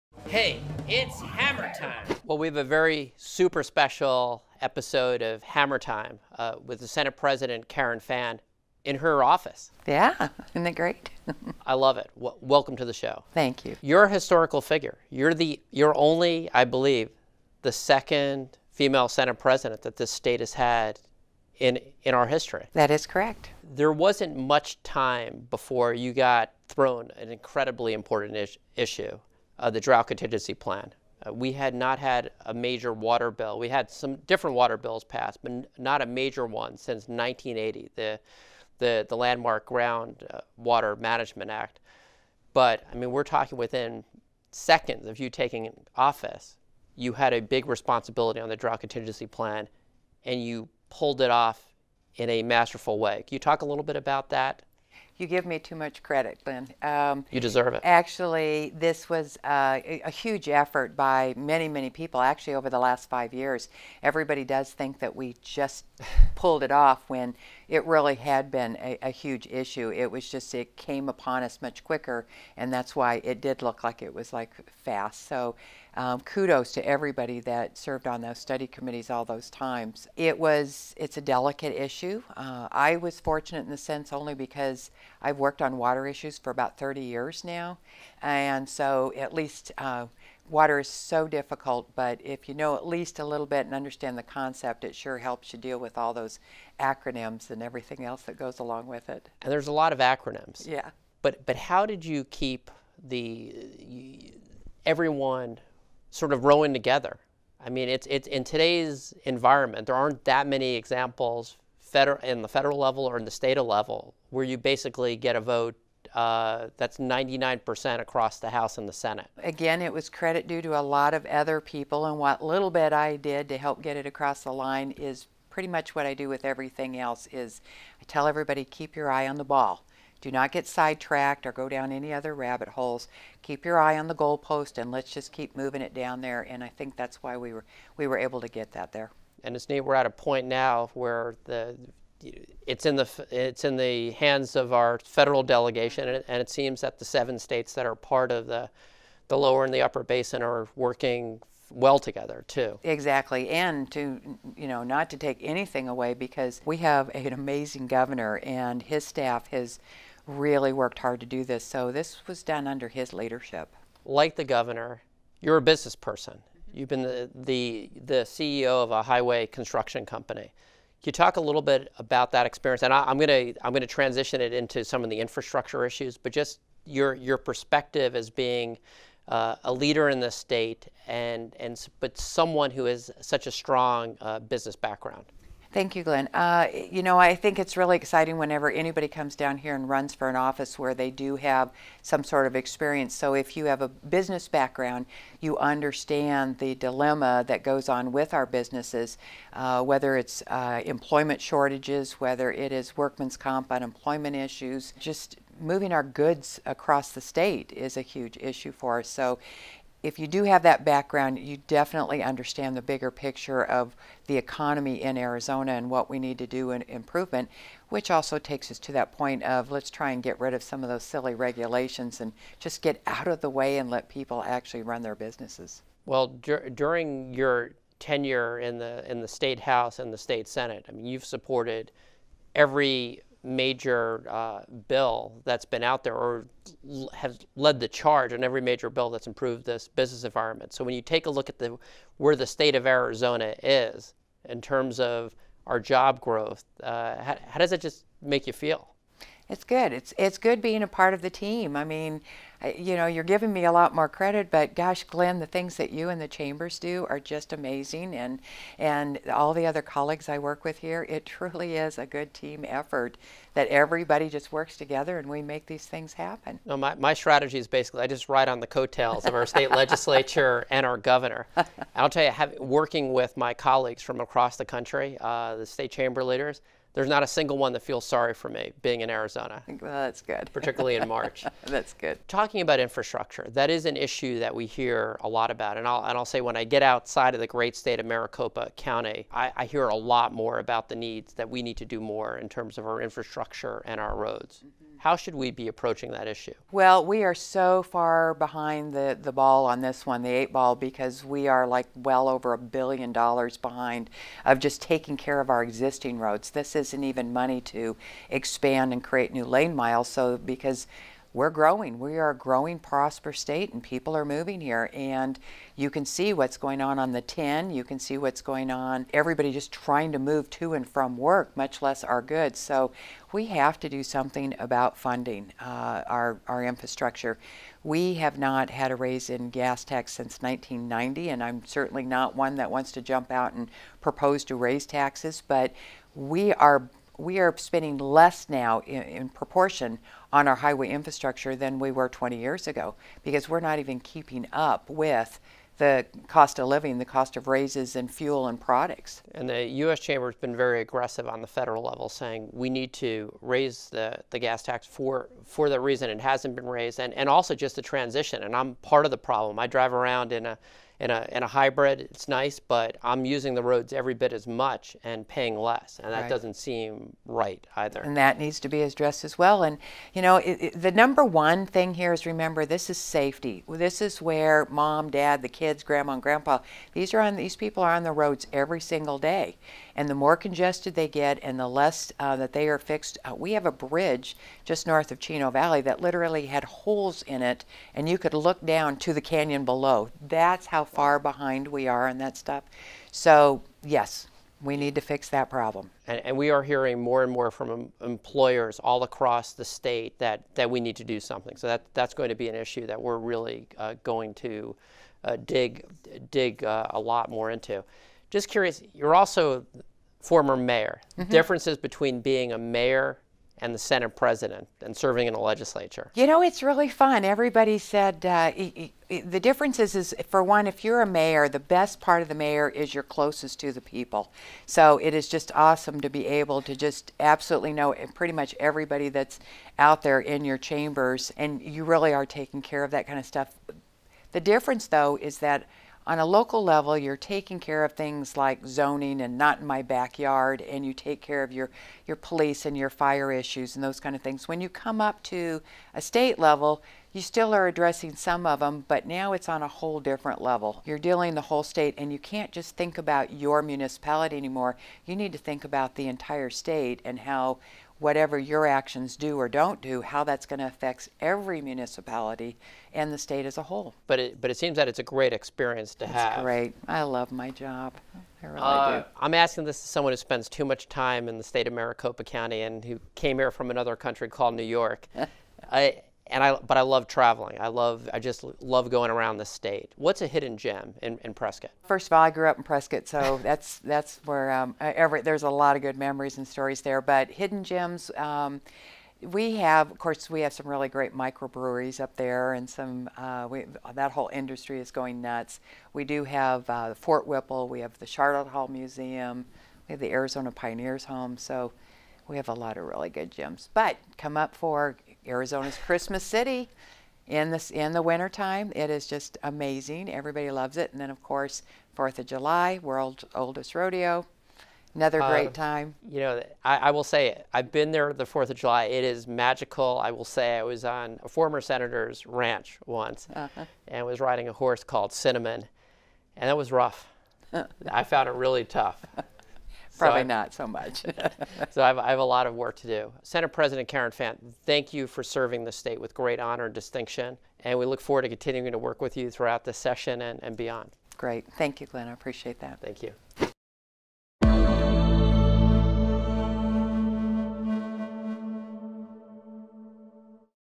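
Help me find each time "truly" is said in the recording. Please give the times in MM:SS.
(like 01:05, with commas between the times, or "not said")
04:21.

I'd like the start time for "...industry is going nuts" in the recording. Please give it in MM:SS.
08:14.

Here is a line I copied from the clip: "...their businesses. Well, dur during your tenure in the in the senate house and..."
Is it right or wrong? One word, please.
wrong.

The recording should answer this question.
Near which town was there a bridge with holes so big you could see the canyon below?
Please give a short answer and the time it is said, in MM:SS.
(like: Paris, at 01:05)
Chino Valley, at 06:25.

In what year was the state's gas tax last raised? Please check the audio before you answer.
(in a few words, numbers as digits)
1990.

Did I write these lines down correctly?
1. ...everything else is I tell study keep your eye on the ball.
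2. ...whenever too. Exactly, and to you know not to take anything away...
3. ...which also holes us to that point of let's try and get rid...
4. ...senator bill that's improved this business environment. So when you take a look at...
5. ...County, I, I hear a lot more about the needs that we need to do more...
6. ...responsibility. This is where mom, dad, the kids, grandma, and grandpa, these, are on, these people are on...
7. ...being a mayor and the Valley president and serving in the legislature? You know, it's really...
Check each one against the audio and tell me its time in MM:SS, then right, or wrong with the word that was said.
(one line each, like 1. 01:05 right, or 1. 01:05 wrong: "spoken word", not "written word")
1. 02:06 wrong: "everybody", not "study"
2. 02:31 wrong: "together", not "whenever"
3. 03:37 wrong: "takes", not "holes"
4. 03:58 wrong: "major", not "senator"
5. 04:48 right
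6. 06:12 wrong: "safety", not "responsibility"
7. 06:52 wrong: "Senate", not "Valley".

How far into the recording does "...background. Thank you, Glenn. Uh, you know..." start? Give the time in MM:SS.
03:04.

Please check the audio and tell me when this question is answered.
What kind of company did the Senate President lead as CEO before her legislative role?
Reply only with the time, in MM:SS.
02:49.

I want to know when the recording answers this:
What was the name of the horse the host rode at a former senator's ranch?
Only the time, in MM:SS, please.
08:45.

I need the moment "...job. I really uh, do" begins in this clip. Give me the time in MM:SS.
07:47.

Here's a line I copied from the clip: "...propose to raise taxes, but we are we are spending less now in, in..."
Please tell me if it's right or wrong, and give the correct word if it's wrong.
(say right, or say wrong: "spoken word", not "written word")
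right.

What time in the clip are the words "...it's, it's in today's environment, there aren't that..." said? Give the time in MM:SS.
01:47.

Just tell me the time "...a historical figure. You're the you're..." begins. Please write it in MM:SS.
00:14.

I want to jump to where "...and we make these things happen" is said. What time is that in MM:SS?
04:25.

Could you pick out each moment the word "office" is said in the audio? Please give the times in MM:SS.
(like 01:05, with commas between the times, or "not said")
00:09, 00:45, 03:10.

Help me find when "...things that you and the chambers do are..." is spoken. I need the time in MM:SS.
04:15.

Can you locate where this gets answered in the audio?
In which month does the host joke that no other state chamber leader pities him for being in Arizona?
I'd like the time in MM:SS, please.
04:41.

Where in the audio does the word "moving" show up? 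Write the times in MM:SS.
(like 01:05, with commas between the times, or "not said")
02:15, 03:25, 05:14.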